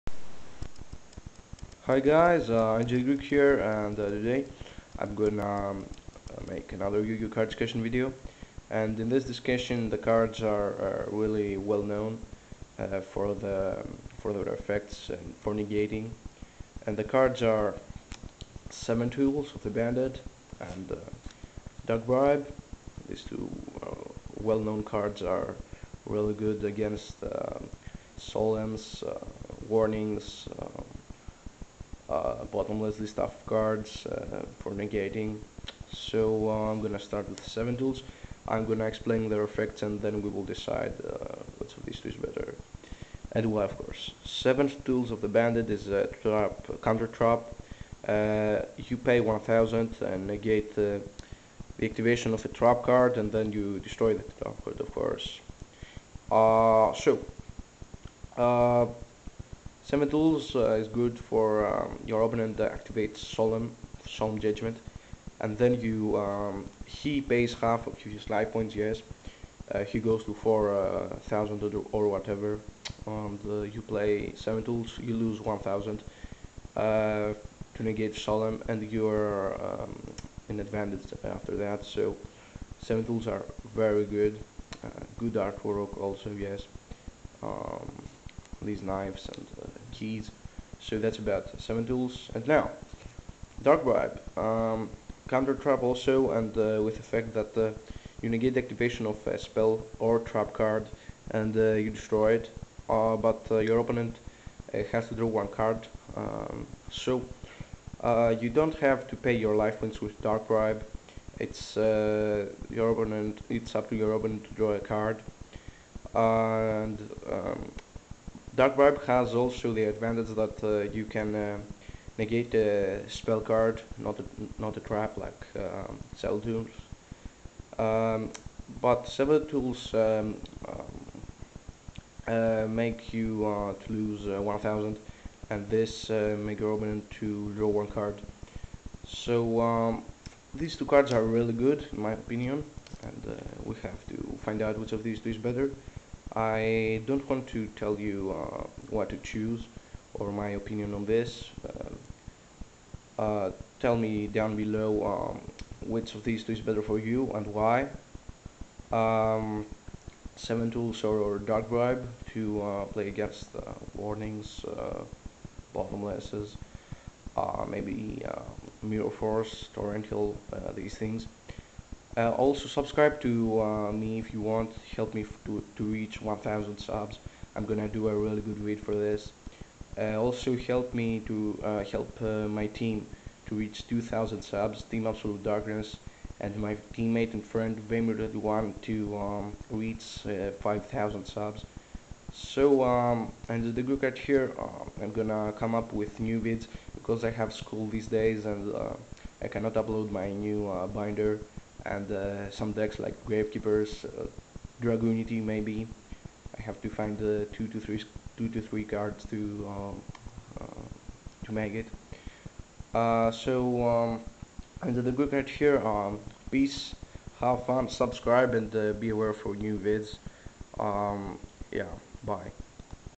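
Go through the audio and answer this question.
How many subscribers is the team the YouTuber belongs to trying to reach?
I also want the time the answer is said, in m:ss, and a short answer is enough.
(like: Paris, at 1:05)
2,000, at 3:03.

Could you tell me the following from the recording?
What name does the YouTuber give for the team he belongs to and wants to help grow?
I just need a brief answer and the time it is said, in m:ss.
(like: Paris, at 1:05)
Team Absolute Darkness, at 3:04.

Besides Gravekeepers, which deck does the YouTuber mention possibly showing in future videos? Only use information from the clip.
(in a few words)
Dragunity.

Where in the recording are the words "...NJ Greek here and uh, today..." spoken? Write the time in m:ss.
0:02.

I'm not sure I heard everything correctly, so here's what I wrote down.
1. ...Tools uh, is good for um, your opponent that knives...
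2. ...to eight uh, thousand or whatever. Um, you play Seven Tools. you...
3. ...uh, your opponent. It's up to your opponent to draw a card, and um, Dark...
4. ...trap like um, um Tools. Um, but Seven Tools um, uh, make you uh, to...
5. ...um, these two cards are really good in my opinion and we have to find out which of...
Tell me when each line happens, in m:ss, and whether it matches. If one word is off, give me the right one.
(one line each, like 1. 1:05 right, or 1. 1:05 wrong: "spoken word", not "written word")
1. 1:00 wrong: "activates", not "knives"
2. 1:10 wrong: "four", not "eight"
3. 1:51 right
4. 2:04 right
5. 2:19 right.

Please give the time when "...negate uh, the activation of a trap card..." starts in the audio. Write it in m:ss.
0:50.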